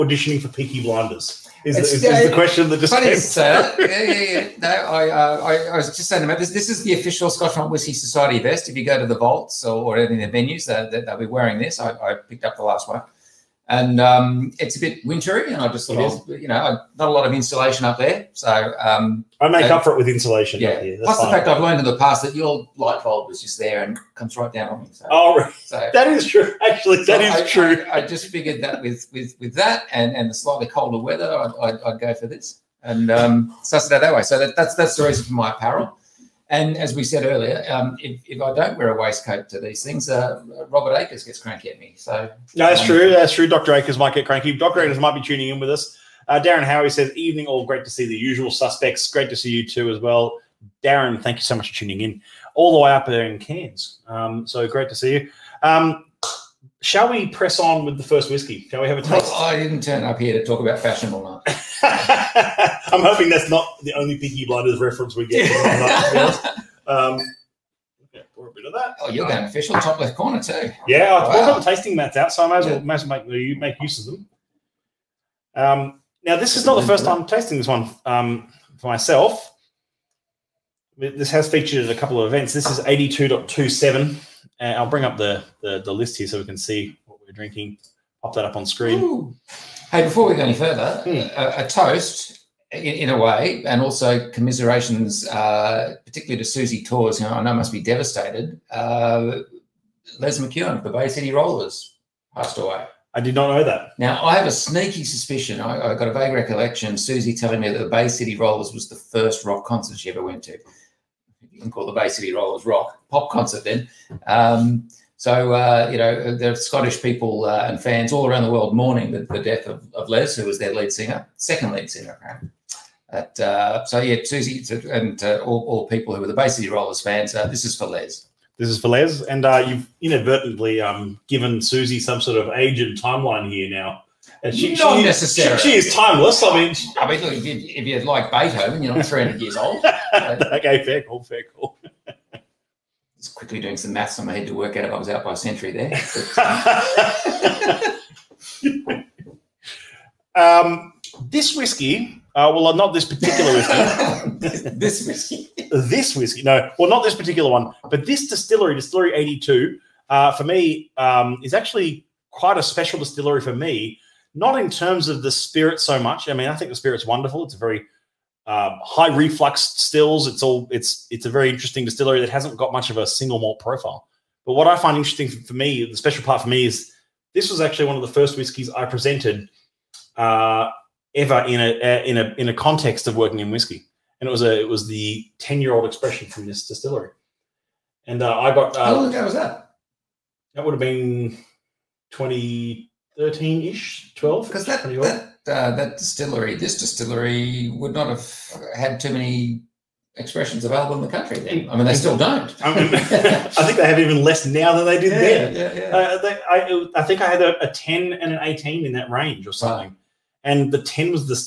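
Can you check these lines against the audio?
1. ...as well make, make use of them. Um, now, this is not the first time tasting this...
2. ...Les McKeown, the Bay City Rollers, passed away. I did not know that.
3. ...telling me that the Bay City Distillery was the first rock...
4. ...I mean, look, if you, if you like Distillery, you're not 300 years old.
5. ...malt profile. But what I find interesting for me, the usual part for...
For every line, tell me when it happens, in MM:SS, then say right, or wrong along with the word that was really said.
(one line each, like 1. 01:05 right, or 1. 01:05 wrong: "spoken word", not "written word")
1. 01:12 right
2. 01:40 right
3. 01:47 wrong: "Rollers", not "Distillery"
4. 02:16 wrong: "Beethoven", not "Distillery"
5. 02:53 wrong: "special", not "usual".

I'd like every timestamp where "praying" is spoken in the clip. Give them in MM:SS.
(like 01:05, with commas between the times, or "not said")
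not said.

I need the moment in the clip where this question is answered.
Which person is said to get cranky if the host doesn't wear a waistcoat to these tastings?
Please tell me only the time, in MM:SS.
00:40.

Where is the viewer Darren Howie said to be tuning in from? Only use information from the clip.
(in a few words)
Cairns.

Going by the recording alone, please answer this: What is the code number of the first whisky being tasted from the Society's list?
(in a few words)
82.27.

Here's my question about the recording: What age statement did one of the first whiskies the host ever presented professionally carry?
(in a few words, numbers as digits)
10 year old.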